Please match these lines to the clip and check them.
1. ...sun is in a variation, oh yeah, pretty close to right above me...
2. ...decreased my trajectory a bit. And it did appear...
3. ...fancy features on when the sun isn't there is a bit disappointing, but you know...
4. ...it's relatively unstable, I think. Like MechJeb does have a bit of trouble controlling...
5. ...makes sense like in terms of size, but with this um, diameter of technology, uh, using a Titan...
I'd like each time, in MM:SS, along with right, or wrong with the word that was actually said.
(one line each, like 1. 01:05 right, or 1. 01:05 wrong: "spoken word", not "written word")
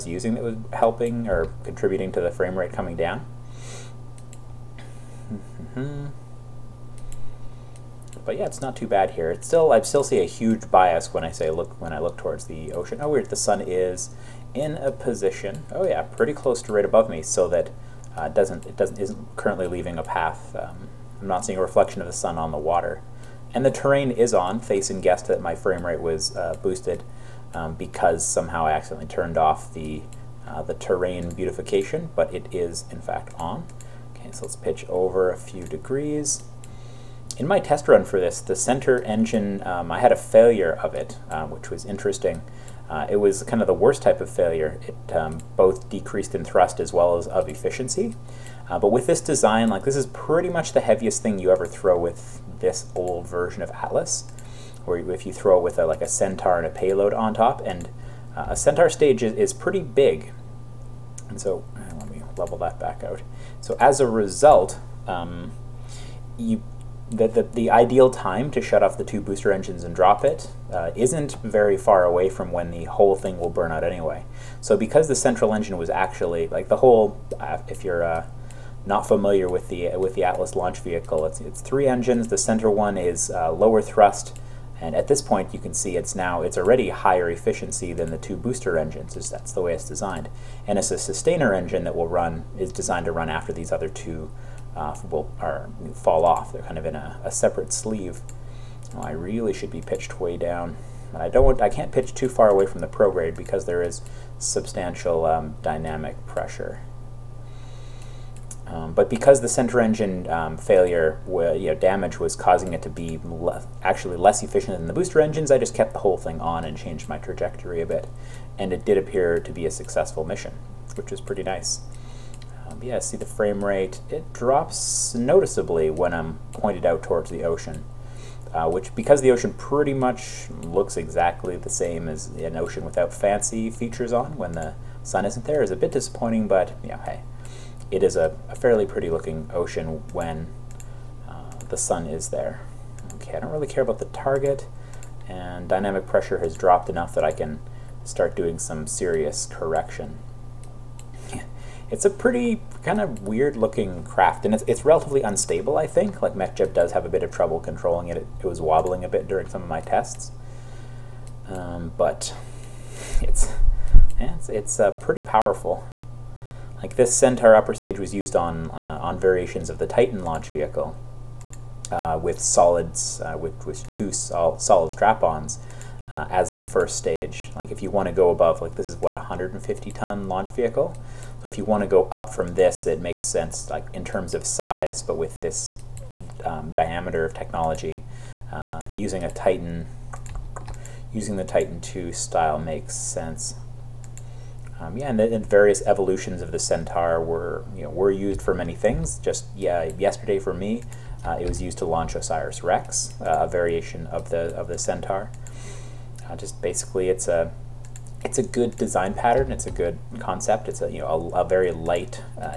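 1. 00:13 wrong: "position", not "variation"
2. 01:56 wrong: "changed", not "decreased"
3. 02:13 right
4. 02:34 right
5. 03:02 right.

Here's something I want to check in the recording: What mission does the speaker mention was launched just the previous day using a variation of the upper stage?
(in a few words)
OSIRIS-REx.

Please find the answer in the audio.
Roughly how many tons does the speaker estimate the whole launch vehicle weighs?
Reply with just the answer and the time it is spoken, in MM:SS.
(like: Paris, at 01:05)
150, at 02:59.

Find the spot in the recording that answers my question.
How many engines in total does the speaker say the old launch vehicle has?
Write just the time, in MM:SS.
01:21.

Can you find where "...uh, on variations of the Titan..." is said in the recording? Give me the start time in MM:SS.
02:48.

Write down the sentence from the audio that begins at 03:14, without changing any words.
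Um, yeah, and, and various evolutions of the Centaur were you know were used for many things.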